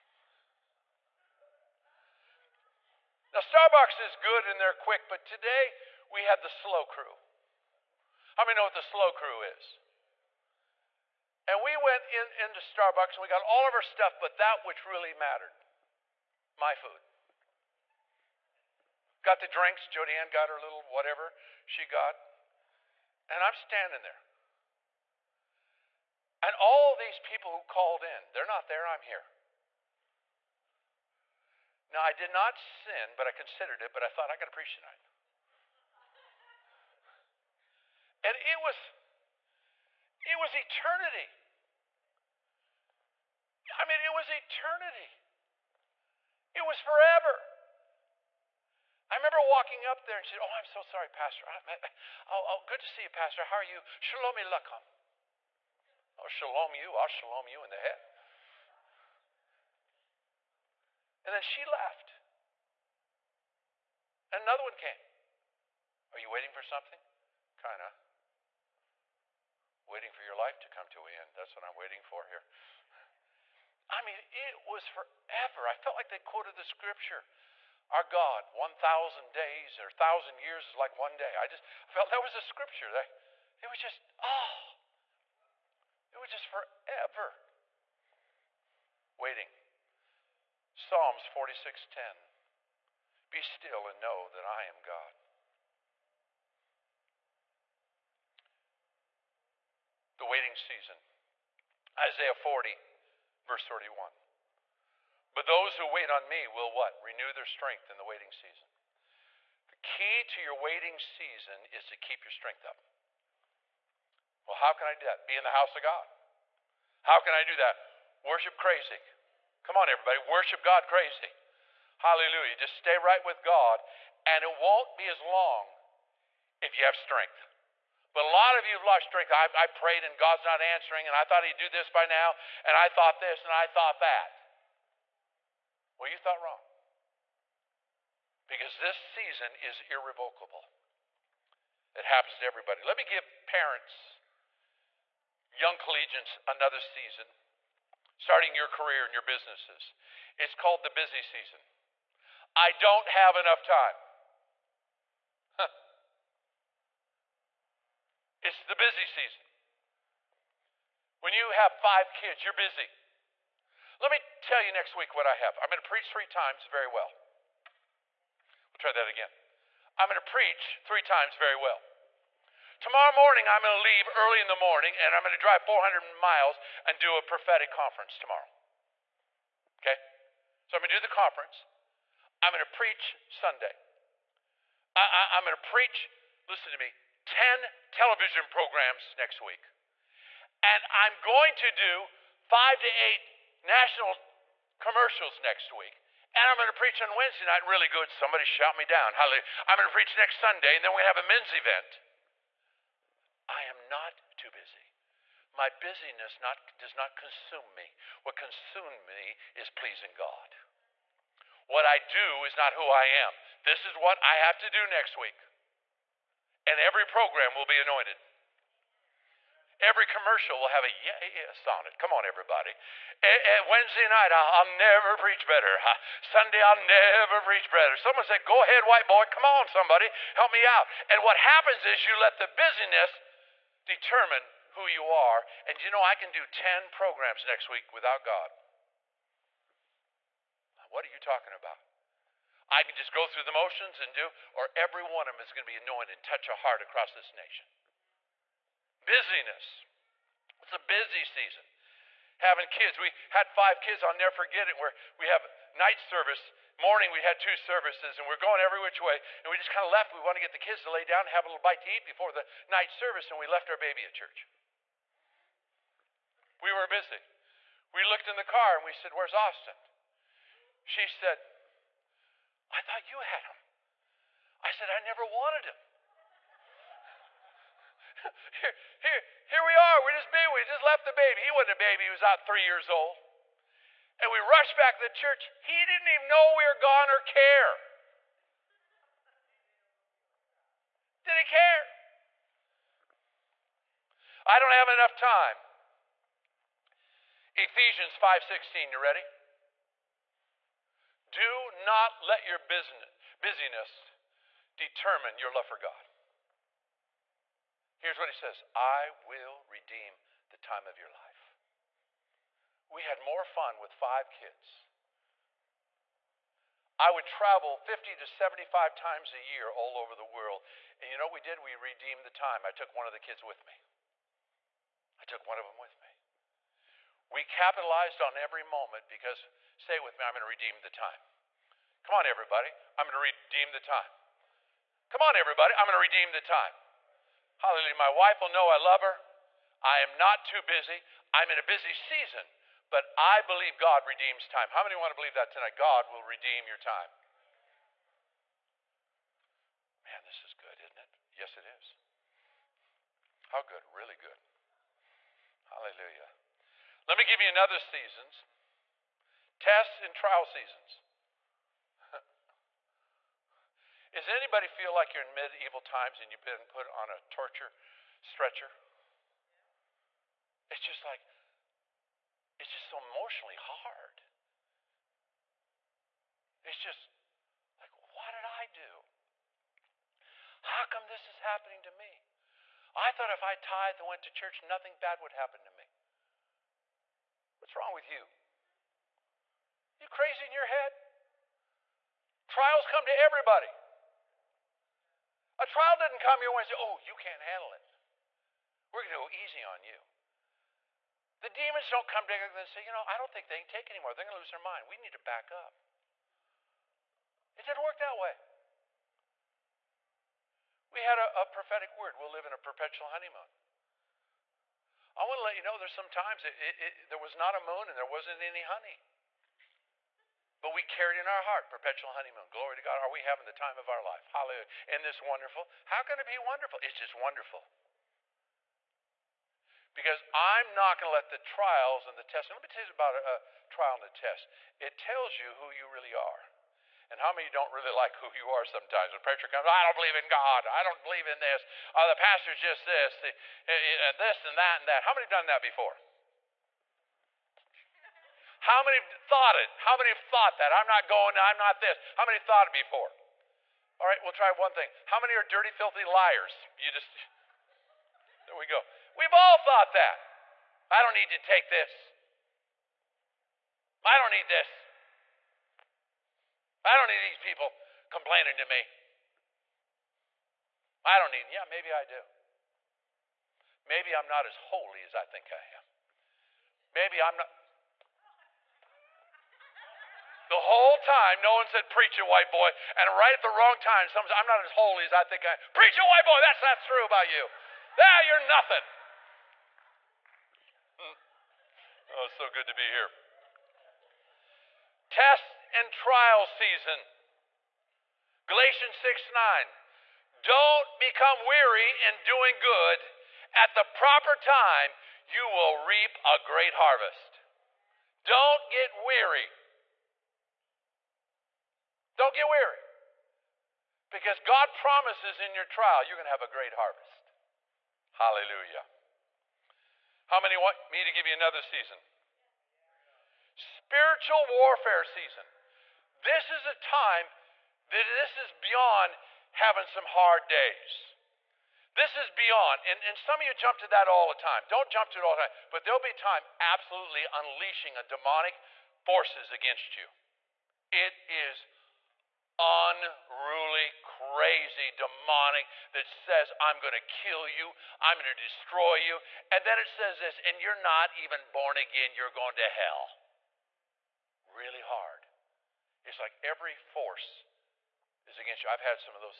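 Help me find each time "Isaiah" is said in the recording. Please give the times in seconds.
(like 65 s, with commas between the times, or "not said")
101 s.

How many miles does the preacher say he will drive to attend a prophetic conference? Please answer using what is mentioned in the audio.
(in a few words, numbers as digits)
400.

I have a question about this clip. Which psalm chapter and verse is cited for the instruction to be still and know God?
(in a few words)
Psalms 46:10.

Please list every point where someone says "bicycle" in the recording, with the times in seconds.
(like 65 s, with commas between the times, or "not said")
not said.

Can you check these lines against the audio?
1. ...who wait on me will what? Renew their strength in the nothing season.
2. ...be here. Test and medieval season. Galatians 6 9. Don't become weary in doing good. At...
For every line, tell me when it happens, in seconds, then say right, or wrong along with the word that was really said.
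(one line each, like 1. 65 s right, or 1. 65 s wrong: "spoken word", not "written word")
1. 105 s wrong: "waiting", not "nothing"
2. 492 s wrong: "trial", not "medieval".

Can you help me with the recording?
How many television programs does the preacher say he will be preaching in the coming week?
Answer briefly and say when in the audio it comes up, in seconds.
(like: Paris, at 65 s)
10, at 187 s.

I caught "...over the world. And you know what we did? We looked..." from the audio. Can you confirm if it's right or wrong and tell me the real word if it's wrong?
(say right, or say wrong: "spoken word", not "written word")
wrong: "redeemed", not "looked".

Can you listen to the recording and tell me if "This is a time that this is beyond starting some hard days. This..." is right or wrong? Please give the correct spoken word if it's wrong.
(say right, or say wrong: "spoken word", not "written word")
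wrong: "having", not "starting".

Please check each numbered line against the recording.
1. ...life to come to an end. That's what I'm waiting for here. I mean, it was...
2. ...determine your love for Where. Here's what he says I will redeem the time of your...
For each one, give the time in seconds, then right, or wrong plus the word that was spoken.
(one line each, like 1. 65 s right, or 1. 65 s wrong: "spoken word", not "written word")
1. 70 s right
2. 304 s wrong: "God", not "Where".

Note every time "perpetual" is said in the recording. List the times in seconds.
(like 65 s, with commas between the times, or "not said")
412 s, 421 s.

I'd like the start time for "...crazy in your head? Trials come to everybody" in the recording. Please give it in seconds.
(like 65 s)
390 s.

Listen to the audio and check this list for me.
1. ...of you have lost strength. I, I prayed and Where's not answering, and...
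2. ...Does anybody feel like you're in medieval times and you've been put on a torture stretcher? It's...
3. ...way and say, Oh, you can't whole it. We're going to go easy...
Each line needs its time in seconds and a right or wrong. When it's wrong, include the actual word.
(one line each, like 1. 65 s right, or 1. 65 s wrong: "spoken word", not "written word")
1. 128 s wrong: "God", not "Where"
2. 364 s right
3. 396 s wrong: "handle", not "whole".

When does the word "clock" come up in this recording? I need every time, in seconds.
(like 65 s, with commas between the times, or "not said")
not said.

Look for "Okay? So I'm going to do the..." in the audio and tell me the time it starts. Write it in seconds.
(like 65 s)
179 s.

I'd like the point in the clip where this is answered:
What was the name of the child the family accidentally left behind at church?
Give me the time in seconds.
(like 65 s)
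269 s.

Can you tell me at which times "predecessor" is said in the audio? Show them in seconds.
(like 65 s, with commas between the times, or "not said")
not said.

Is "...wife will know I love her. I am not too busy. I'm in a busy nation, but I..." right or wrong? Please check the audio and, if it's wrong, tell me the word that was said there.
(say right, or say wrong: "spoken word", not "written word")
wrong: "season", not "nation".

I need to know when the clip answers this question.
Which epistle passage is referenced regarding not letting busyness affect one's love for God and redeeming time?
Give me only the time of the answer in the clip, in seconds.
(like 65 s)
297 s.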